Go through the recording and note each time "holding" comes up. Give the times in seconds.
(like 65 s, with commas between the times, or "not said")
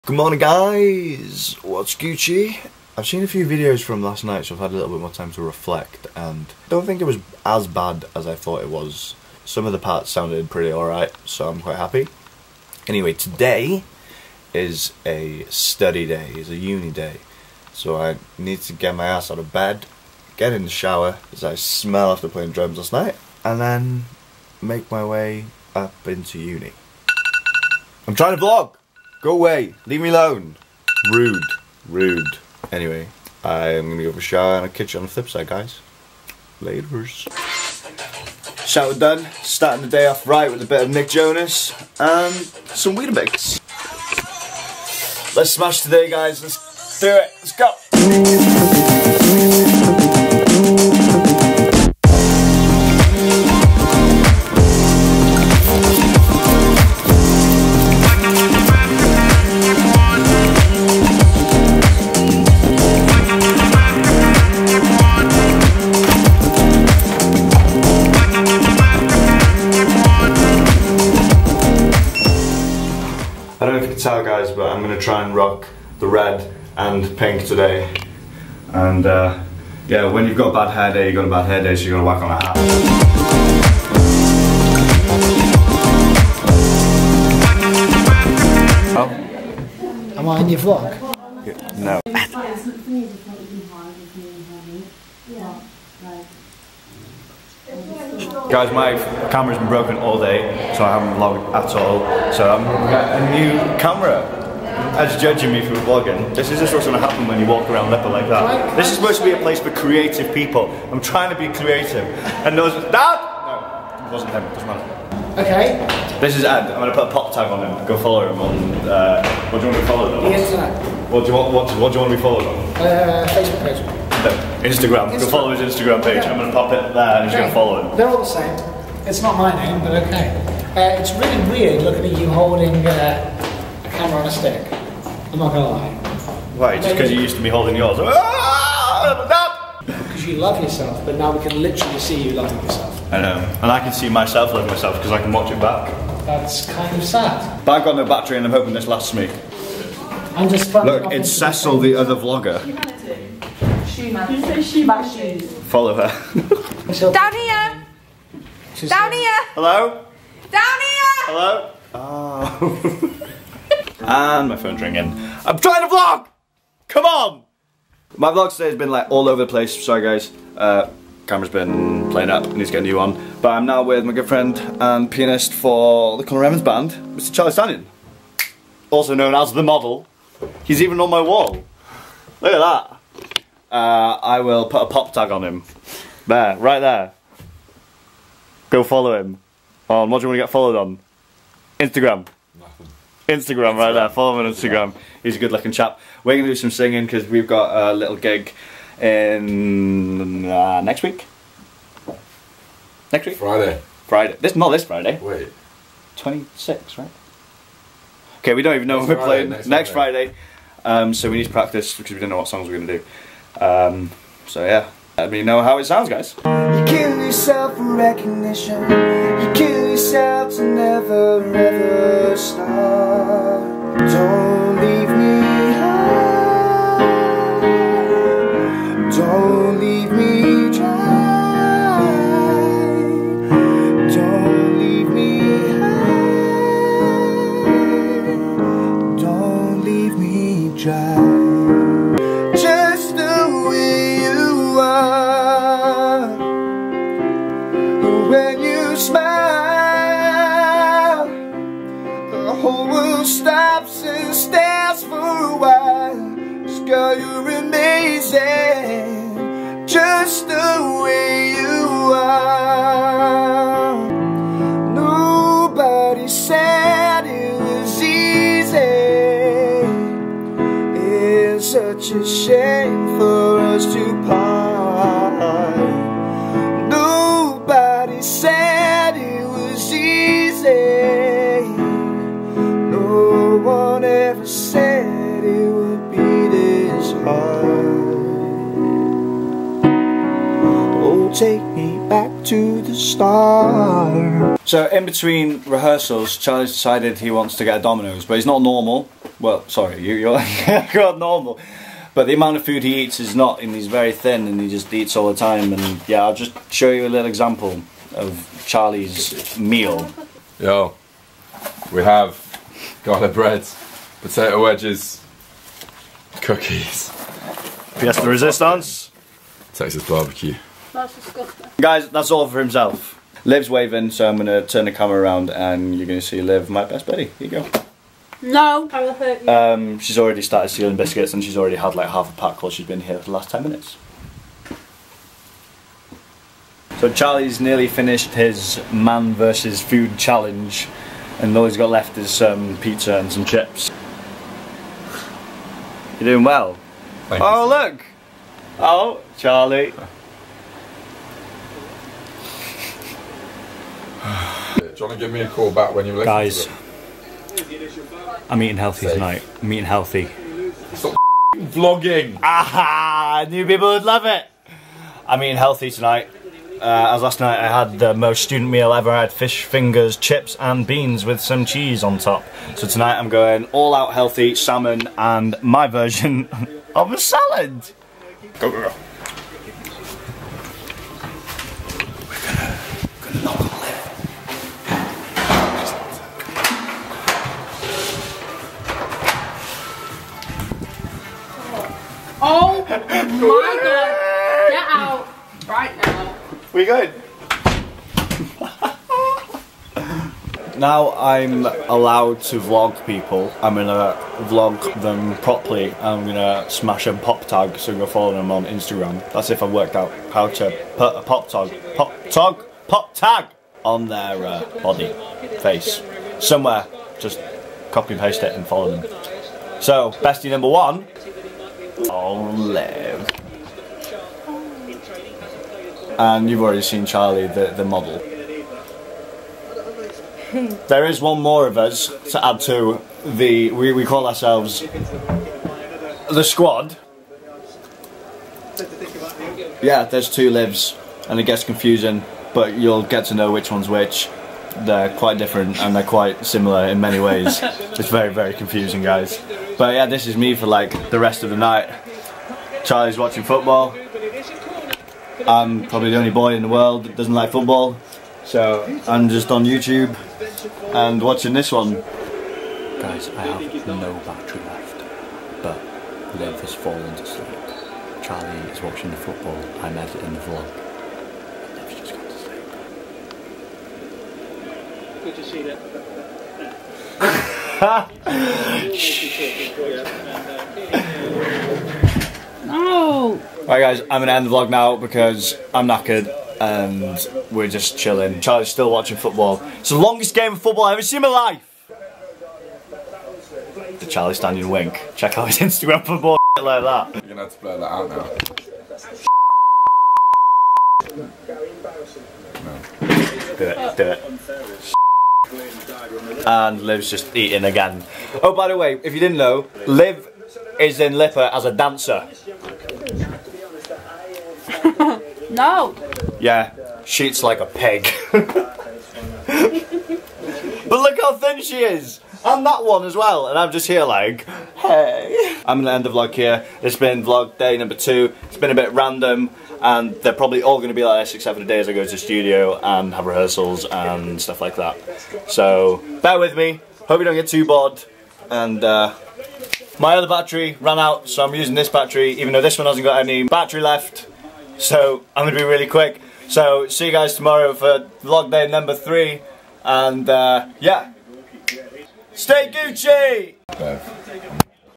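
132 s, 137 s.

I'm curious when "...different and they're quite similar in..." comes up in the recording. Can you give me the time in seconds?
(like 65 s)
445 s.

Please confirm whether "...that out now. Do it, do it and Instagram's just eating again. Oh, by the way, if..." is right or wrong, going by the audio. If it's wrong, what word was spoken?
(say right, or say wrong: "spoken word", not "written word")
wrong: "Liv", not "Instagram".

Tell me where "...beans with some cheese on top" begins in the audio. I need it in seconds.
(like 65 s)
370 s.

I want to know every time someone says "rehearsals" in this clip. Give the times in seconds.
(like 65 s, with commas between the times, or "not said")
295 s, 533 s.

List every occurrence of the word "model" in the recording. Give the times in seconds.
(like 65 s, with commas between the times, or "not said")
179 s, 427 s.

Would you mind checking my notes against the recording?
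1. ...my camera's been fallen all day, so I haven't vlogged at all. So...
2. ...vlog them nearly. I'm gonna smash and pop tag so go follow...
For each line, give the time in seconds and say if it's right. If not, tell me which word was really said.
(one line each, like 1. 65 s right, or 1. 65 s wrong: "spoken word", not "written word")
1. 98 s wrong: "broken", not "fallen"
2. 404 s wrong: "properly", not "nearly".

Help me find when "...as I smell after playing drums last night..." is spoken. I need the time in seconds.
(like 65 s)
21 s.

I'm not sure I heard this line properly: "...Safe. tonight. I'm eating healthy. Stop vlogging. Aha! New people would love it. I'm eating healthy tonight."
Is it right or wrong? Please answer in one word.
right.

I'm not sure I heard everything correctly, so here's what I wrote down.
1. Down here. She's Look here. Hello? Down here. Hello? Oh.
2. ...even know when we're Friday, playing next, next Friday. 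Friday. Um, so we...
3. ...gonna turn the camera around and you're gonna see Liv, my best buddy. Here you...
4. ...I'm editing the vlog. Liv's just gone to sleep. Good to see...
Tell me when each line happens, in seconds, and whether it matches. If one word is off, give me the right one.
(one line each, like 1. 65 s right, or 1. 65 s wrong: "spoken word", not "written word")
1. 157 s wrong: "Down", not "Look"
2. 208 s right
3. 324 s right
4. 469 s right.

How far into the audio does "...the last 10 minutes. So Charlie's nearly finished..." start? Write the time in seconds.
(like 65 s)
333 s.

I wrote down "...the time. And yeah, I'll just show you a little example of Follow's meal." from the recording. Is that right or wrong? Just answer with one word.
wrong.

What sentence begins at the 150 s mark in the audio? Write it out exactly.
I'm just Look, it's Cecil, the other vlogger.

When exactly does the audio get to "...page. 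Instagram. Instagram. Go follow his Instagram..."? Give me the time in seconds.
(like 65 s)
124 s.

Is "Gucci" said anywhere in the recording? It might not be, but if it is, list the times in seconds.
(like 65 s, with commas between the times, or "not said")
1 s, 552 s.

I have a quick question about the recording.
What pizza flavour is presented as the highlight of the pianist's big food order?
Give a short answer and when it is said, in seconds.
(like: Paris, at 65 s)
Texas barbecue, at 319 s.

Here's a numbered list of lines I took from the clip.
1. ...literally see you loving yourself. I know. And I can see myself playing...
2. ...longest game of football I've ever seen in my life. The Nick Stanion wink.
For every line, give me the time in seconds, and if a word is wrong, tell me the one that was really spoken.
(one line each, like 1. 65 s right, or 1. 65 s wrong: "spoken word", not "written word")
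1. 141 s wrong: "loving", not "playing"
2. 489 s wrong: "Charlie", not "Nick".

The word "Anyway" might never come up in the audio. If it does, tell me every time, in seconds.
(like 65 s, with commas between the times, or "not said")
12 s, 32 s.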